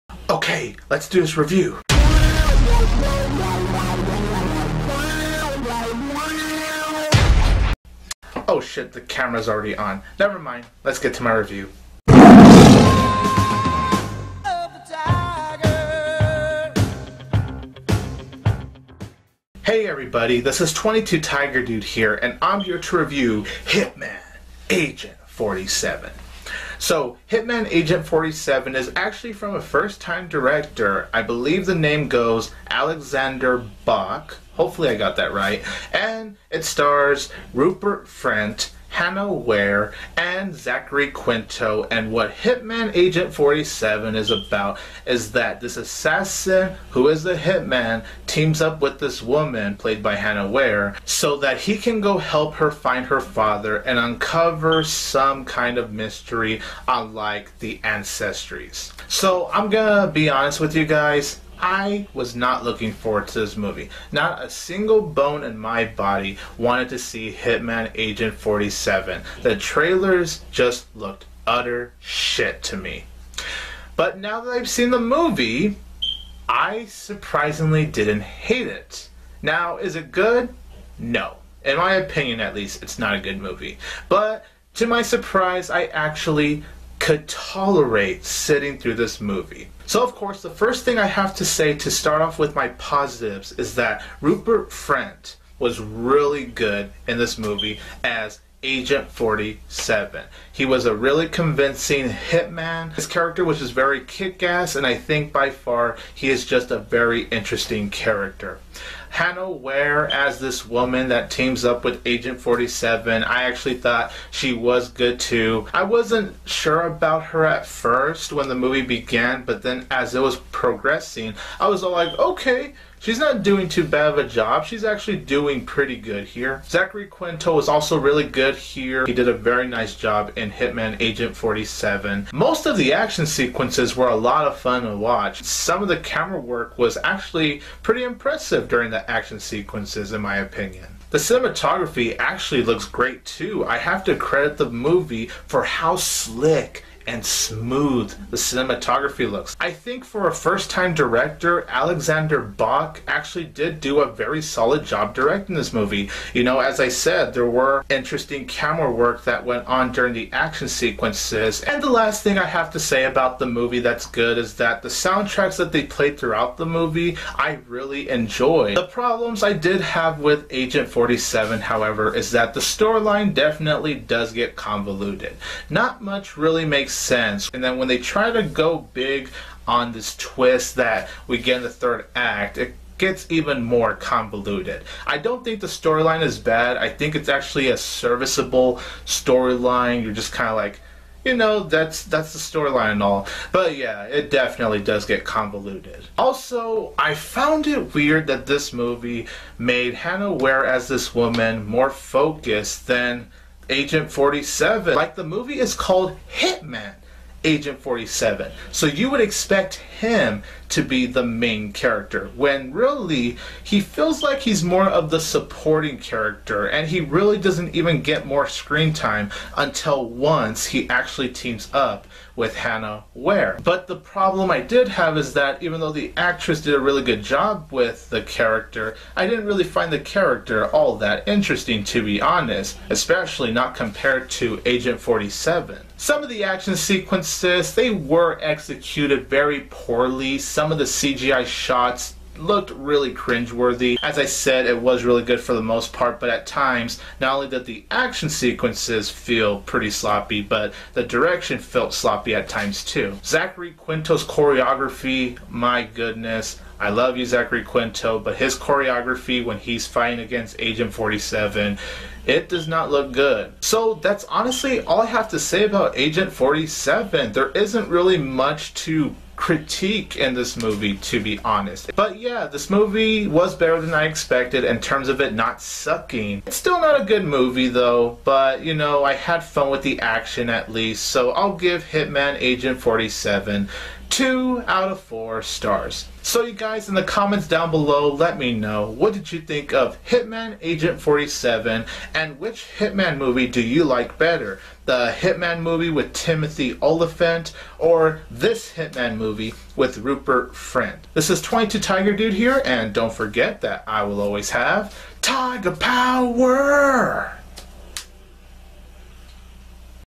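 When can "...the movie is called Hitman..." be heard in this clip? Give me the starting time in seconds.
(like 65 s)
205 s.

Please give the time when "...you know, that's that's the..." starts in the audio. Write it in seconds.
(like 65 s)
191 s.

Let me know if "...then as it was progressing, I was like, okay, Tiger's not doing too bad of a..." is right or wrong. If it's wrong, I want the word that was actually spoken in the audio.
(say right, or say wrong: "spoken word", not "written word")
wrong: "She", not "Tiger".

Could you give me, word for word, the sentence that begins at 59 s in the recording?
So I'm gonna be honest with you guys.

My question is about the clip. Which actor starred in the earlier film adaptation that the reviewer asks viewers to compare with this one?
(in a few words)
Timothy Olyphant.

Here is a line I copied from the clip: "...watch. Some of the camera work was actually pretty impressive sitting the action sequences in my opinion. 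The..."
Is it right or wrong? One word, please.
wrong.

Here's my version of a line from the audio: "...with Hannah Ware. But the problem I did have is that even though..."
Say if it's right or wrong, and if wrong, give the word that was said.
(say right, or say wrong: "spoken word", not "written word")
right.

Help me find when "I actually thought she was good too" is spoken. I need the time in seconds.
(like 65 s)
113 s.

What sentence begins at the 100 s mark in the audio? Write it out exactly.
He was a really convincing hitman.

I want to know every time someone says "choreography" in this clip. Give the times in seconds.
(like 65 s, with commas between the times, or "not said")
254 s, 258 s.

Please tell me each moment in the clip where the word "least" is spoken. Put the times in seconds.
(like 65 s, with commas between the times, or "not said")
82 s, 280 s.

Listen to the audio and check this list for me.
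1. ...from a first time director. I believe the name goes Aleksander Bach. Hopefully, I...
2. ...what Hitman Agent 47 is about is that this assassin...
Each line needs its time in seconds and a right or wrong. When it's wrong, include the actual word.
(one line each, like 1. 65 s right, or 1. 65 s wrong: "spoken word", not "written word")
1. 29 s right
2. 42 s right.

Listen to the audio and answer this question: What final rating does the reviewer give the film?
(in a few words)
2 out of 4 stars.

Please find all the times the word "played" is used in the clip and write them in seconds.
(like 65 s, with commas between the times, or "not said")
49 s, 165 s.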